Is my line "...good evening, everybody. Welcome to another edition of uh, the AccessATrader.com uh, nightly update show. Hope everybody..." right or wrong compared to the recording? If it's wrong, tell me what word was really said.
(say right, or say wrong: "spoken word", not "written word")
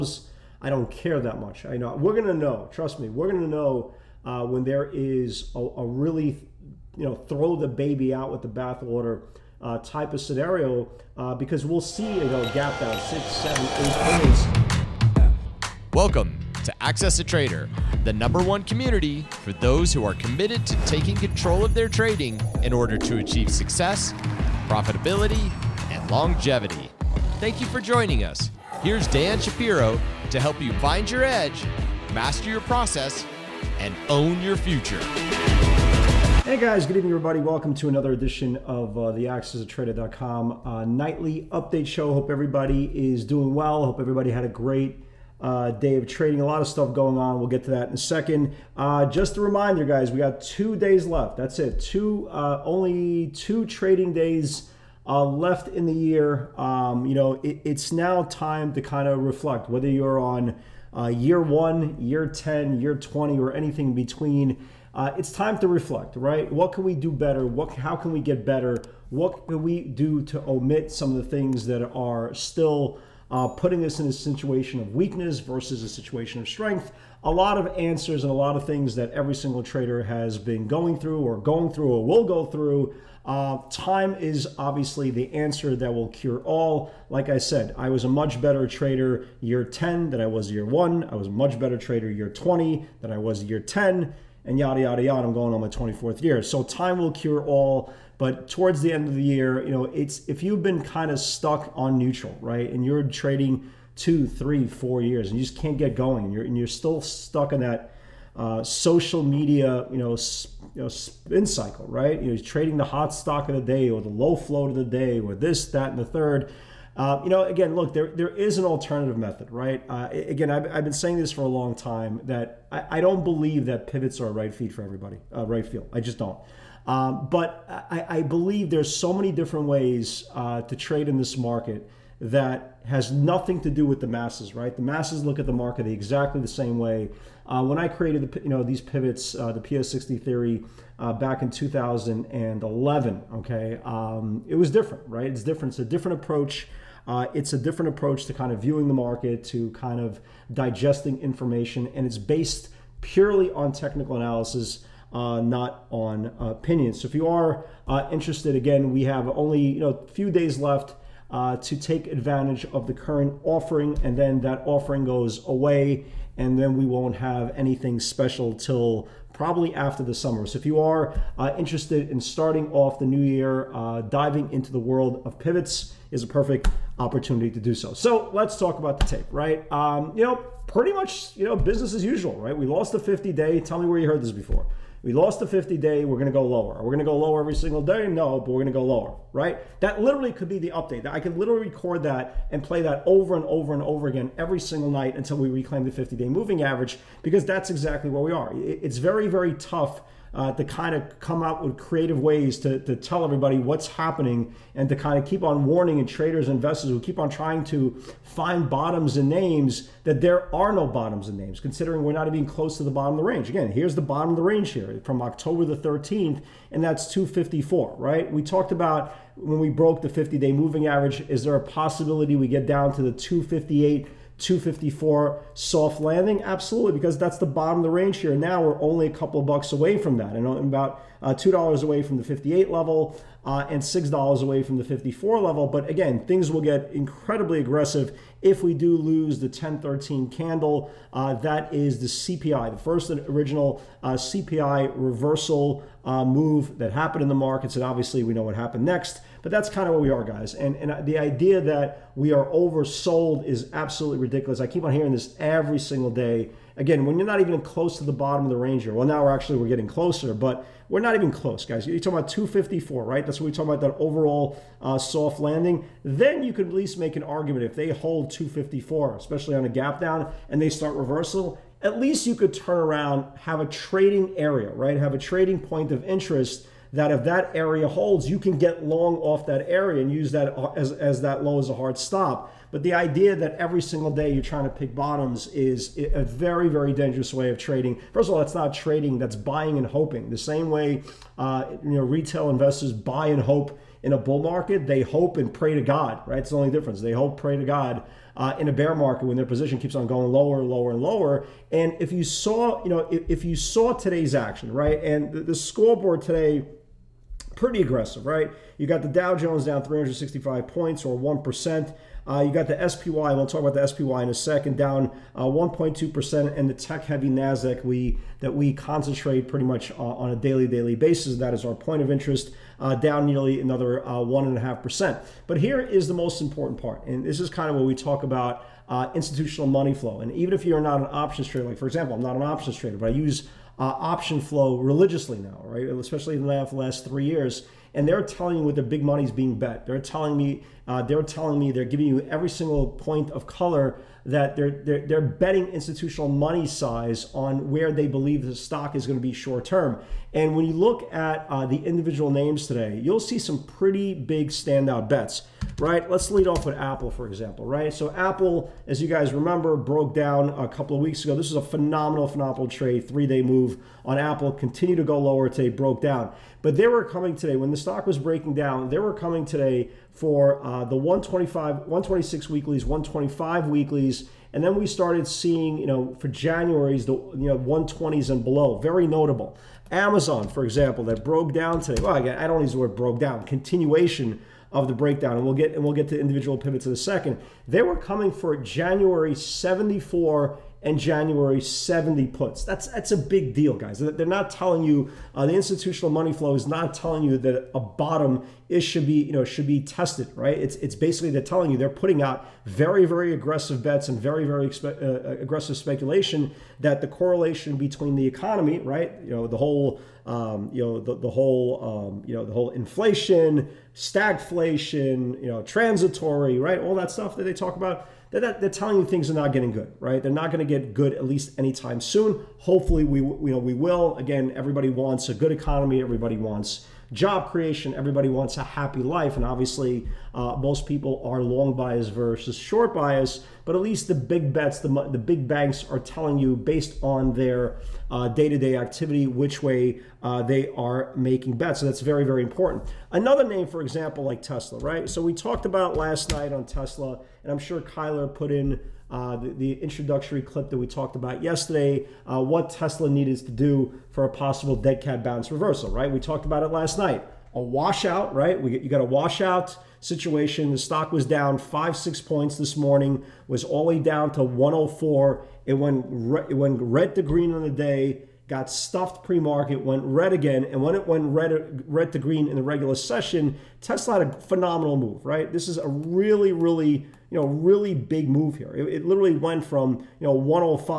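right.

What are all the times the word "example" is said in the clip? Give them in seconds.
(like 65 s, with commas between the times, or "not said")
331 s, 357 s, 380 s, 443 s.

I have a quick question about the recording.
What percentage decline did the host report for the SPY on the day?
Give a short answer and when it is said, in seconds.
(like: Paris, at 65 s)
1.2%, at 315 s.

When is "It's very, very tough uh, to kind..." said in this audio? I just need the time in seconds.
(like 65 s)
198 s.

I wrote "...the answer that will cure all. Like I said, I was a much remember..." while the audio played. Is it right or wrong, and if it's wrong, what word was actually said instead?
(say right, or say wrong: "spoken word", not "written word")
wrong: "better", not "remember".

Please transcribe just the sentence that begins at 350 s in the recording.
And when you look at uh, the individual names today, you'll see some pretty big standout bets, right?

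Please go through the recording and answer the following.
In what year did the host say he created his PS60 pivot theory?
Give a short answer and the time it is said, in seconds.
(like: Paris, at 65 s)
2011, at 141 s.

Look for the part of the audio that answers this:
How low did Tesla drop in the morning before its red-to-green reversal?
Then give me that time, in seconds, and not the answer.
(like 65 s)
464 s.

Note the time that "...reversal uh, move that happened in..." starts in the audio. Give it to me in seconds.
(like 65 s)
244 s.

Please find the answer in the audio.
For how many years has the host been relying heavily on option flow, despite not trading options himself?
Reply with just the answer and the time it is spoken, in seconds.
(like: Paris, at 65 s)
3, at 337 s.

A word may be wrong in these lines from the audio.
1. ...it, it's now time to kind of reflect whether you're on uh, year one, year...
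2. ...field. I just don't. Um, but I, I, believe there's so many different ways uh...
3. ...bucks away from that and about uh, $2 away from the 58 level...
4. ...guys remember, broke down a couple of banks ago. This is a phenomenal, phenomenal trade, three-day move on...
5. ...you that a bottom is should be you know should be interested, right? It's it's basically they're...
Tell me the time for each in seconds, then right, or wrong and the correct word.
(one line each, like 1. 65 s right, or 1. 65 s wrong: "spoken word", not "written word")
1. 57 s right
2. 125 s right
3. 229 s right
4. 359 s wrong: "weeks", not "banks"
5. 397 s wrong: "tested", not "interested".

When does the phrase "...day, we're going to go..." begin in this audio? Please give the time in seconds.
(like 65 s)
185 s.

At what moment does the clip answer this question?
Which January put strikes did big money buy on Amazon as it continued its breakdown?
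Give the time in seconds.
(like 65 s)
388 s.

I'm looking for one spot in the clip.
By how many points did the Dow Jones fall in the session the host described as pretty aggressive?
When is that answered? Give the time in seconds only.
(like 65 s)
309 s.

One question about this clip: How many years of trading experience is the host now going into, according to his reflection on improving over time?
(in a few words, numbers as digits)
24th year.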